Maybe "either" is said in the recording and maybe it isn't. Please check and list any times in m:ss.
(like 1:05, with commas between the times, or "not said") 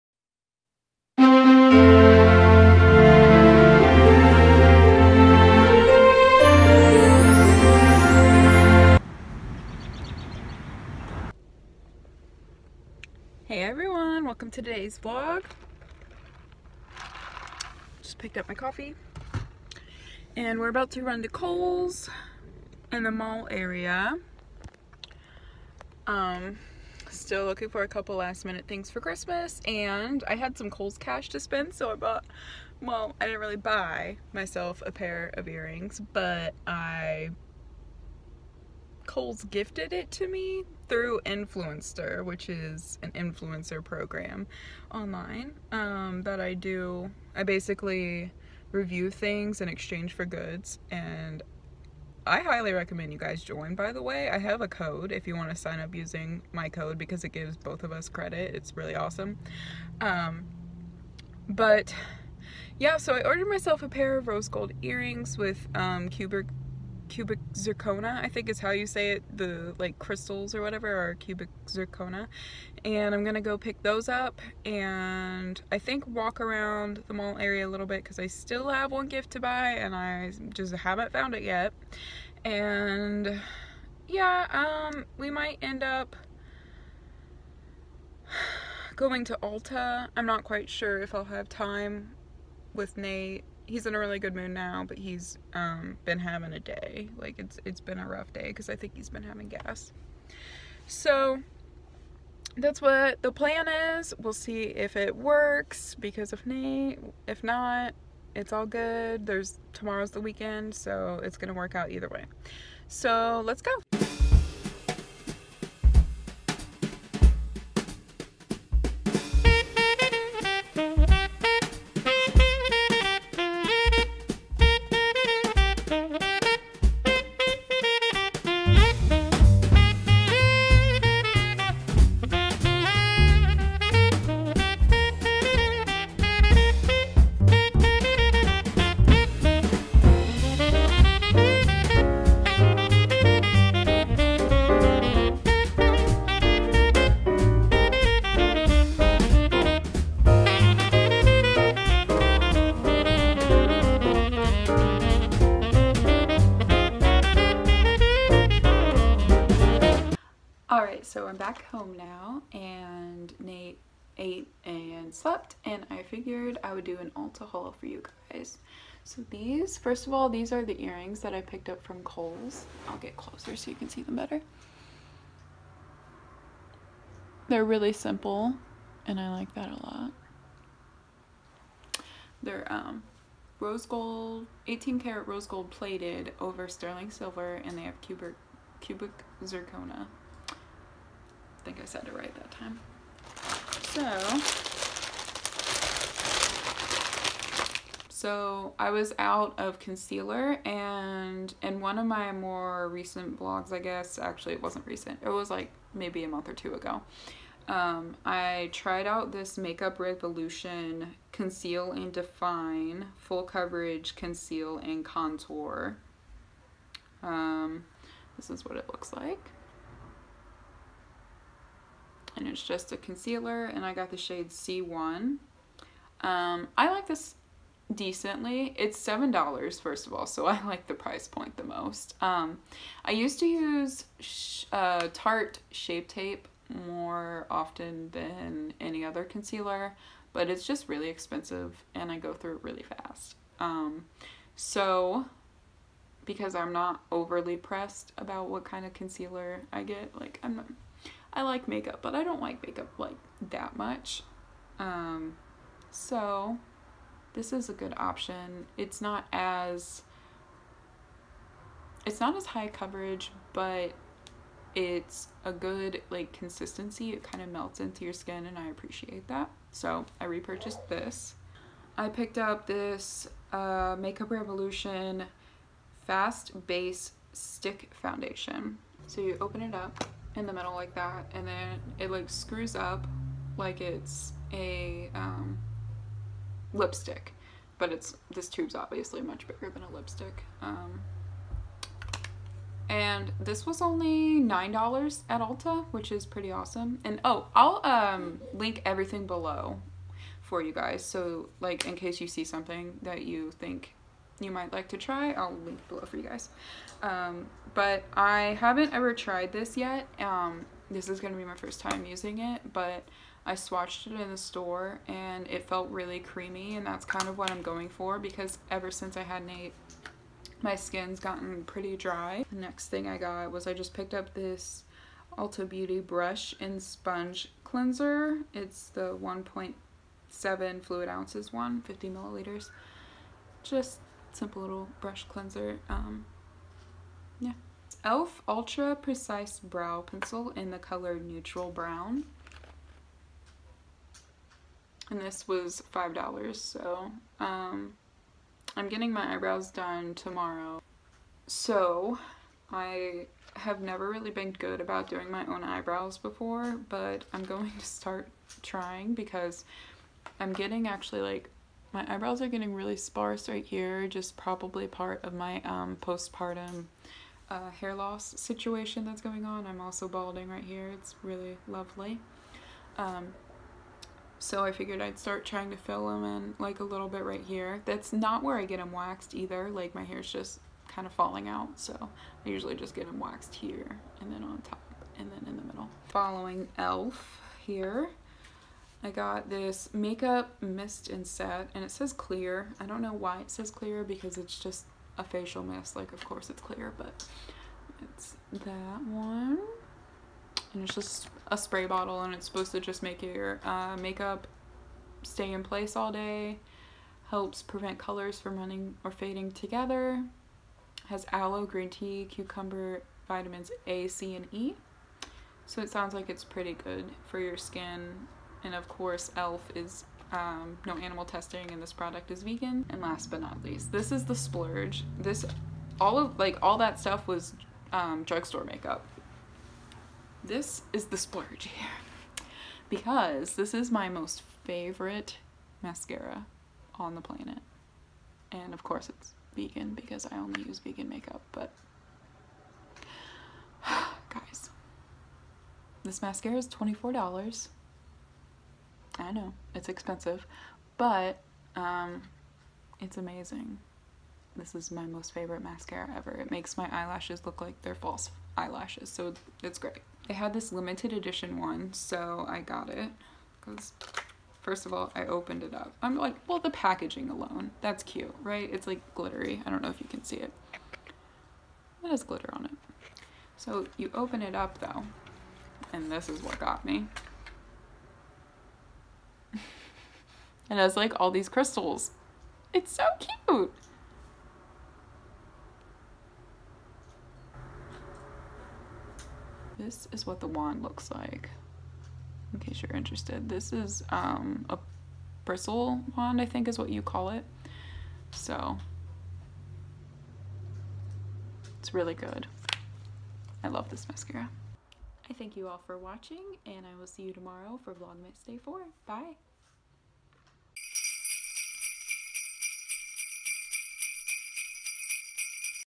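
1:51, 6:19.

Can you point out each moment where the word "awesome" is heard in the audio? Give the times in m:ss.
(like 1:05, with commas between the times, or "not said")
0:58, 4:56.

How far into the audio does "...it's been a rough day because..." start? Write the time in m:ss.
1:37.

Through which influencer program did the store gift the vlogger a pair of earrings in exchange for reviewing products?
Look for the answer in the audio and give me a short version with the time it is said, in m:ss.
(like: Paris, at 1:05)
Influenster, at 0:41.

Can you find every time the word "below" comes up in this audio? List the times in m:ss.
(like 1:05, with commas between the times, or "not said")
4:59, 5:05.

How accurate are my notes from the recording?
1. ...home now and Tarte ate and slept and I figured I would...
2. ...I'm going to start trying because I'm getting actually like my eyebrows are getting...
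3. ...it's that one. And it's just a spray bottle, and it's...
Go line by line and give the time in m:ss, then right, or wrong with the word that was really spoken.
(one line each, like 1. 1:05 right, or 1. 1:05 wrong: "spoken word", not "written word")
1. 2:41 wrong: "Nate", not "Tarte"
2. 5:57 right
3. 6:38 right.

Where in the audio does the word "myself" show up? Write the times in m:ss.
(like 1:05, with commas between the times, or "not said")
0:34, 1:03.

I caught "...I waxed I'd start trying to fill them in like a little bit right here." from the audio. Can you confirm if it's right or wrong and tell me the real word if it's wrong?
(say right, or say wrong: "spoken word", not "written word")
wrong: "figured", not "waxed".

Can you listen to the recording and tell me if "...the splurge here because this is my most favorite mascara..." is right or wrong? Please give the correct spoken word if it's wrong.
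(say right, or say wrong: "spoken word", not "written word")
right.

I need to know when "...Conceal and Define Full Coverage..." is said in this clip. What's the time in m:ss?
3:31.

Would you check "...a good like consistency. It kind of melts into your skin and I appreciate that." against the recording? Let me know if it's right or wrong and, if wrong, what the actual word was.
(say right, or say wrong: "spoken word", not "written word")
right.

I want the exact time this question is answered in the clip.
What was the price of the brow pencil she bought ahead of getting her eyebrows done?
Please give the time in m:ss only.
5:45.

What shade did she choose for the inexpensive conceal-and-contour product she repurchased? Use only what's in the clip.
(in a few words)
C1.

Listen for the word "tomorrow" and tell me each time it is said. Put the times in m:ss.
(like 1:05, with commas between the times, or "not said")
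1:49, 5:50, 8:27.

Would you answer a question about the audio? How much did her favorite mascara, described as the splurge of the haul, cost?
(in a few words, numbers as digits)
$24.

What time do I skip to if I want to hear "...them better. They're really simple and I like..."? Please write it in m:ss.
2:54.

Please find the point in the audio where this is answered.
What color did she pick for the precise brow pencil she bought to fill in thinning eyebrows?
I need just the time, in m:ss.
5:41.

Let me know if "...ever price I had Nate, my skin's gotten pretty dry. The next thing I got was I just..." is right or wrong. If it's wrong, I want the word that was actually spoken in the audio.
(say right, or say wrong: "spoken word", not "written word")
wrong: "since", not "price".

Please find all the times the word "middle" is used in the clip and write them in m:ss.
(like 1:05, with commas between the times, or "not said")
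4:40, 6:25.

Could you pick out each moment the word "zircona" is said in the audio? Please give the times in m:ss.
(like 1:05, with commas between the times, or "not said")
1:07, 1:11.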